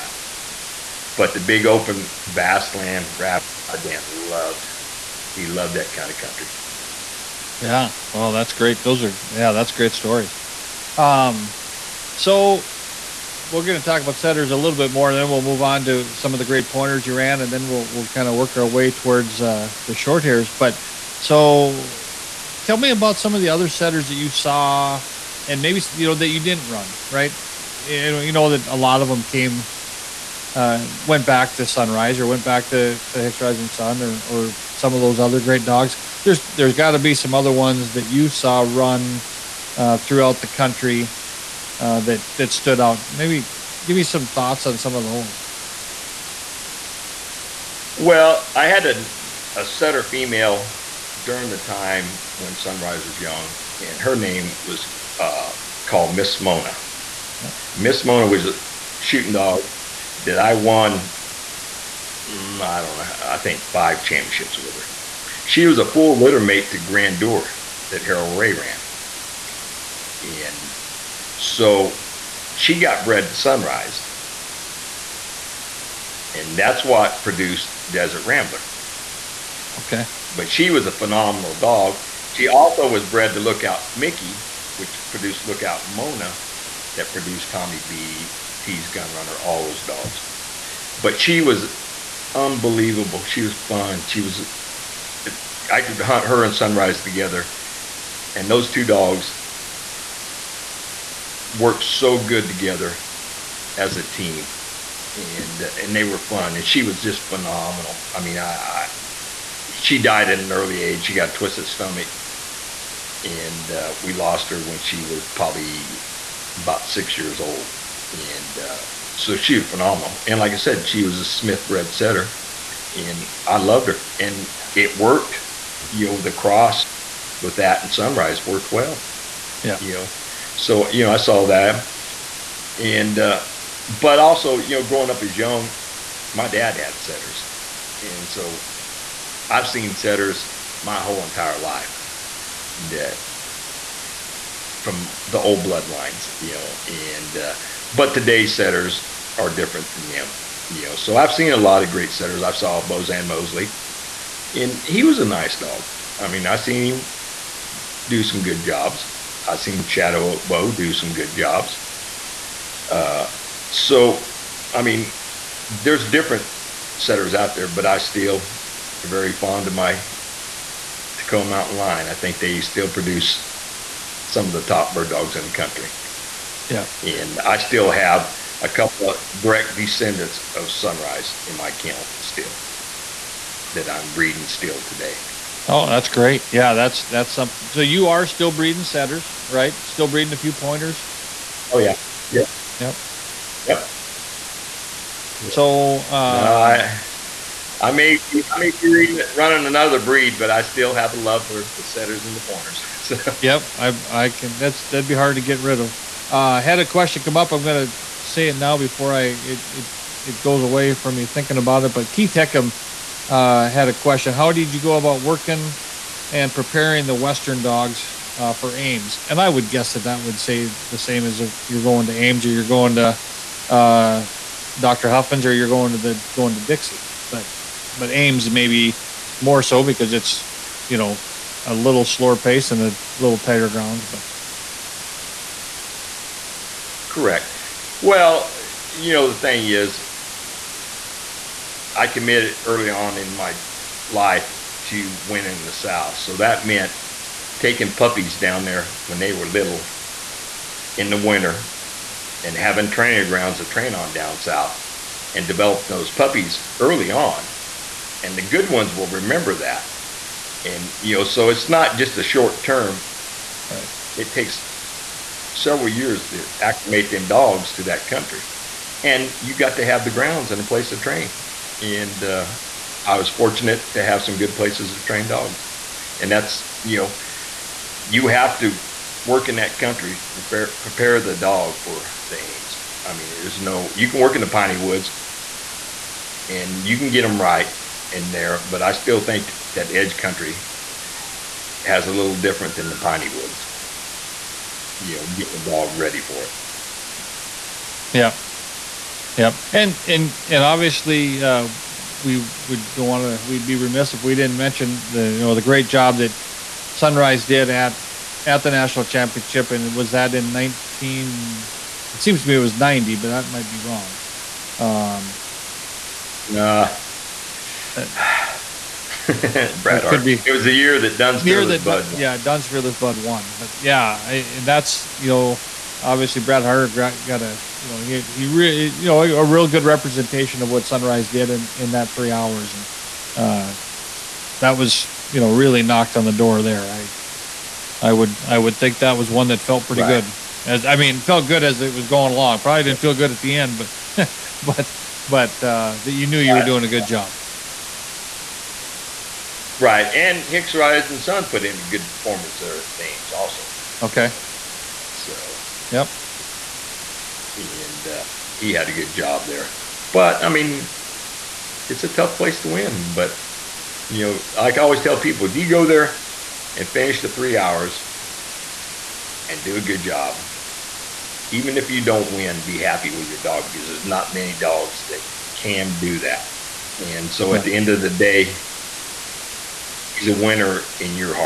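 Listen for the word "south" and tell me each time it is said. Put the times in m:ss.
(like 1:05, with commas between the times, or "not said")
4:05, 4:14.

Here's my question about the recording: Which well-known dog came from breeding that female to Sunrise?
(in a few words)
Desert Rambler.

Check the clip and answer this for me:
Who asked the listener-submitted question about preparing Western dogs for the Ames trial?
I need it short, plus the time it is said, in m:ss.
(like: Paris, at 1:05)
Keith Heckam, at 3:32.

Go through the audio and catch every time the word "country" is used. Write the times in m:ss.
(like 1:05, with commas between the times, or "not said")
0:06, 0:40, 2:55, 4:28, 4:39, 4:50.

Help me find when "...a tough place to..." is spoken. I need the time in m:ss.
6:02.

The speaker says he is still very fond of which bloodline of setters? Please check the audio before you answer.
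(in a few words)
Tekoa Mountain.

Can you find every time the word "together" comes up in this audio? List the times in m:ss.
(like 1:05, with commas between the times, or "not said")
1:37, 1:42.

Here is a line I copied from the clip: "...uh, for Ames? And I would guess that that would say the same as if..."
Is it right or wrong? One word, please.
right.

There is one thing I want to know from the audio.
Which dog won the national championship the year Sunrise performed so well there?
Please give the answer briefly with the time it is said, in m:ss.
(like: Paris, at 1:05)
Duns Fearless Bud, at 5:22.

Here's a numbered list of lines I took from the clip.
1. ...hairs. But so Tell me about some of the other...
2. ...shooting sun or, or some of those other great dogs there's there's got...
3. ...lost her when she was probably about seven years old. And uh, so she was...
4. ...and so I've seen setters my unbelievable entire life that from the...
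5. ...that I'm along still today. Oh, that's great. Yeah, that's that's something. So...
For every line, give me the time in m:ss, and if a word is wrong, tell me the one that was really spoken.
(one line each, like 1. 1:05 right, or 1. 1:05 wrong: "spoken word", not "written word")
1. 0:20 right
2. 0:33 wrong: "rising", not "shooting"
3. 1:54 wrong: "six", not "seven"
4. 2:17 wrong: "whole", not "unbelievable"
5. 3:03 wrong: "breeding", not "along".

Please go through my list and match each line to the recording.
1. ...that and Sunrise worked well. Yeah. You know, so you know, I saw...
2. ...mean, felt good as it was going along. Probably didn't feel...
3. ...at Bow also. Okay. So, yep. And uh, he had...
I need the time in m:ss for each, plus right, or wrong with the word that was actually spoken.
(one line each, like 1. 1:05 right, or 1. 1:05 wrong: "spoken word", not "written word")
1. 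2:07 right
2. 5:40 right
3. 5:52 wrong: "Ames", not "Bow".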